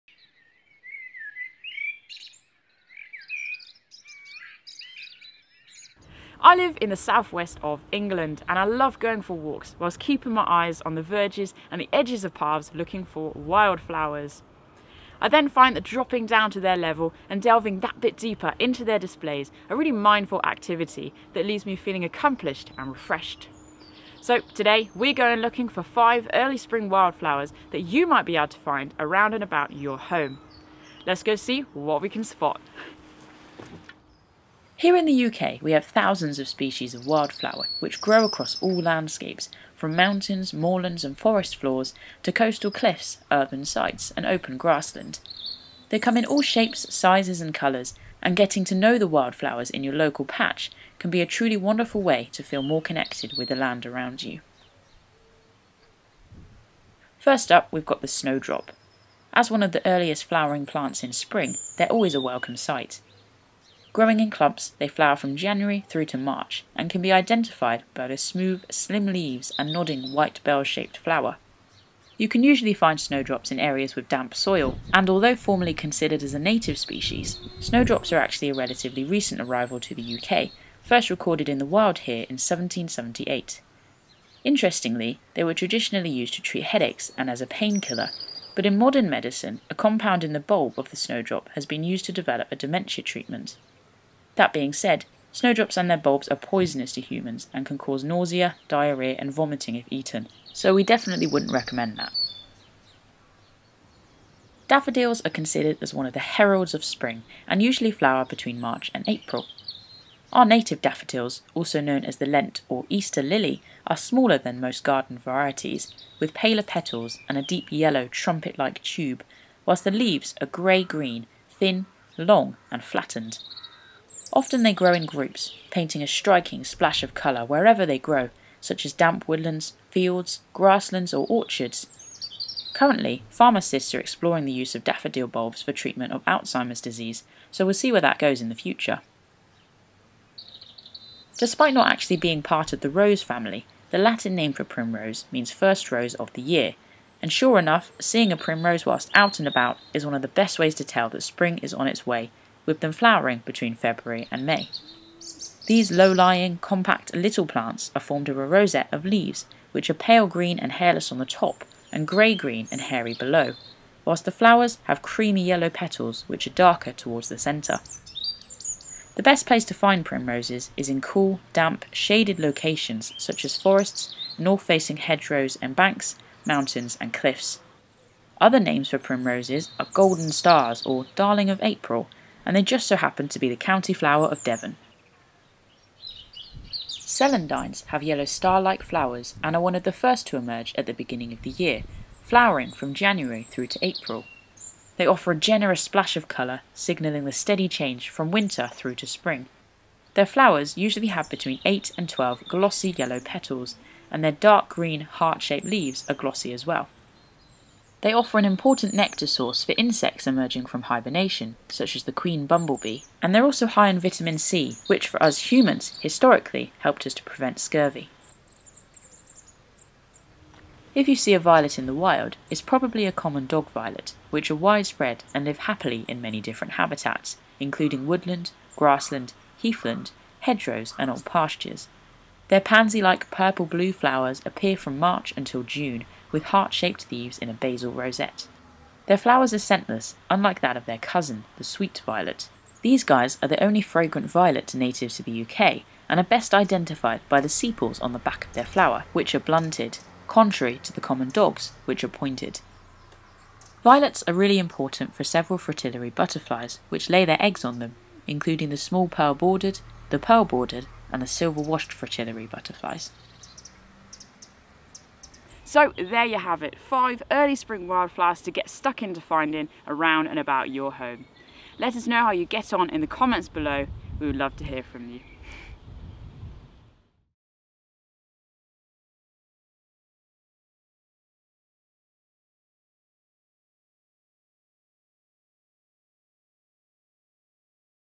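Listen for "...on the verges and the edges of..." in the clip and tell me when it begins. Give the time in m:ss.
0:10.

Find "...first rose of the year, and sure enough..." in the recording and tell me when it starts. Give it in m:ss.
2:25.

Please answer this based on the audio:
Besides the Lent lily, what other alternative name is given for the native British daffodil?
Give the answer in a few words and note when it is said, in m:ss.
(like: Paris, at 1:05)
Easter lily, at 1:52.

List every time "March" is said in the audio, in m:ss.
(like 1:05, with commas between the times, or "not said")
1:06, 1:48, 3:54.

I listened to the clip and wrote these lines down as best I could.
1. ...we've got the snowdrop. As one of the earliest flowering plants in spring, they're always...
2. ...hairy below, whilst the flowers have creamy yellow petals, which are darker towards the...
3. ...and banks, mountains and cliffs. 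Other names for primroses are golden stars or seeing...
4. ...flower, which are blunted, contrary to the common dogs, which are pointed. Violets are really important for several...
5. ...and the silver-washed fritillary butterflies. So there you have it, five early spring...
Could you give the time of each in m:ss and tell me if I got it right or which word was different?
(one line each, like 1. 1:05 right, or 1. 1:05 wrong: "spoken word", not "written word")
1. 0:57 right
2. 2:42 right
3. 2:55 wrong: "darling", not "seeing"
4. 4:08 right
5. 4:21 right.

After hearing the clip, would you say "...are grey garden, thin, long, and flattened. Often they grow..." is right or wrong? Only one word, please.
wrong.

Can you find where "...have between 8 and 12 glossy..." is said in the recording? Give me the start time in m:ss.
3:21.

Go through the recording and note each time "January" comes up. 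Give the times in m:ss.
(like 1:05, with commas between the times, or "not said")
1:05, 3:12.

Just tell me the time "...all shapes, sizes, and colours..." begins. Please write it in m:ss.
0:46.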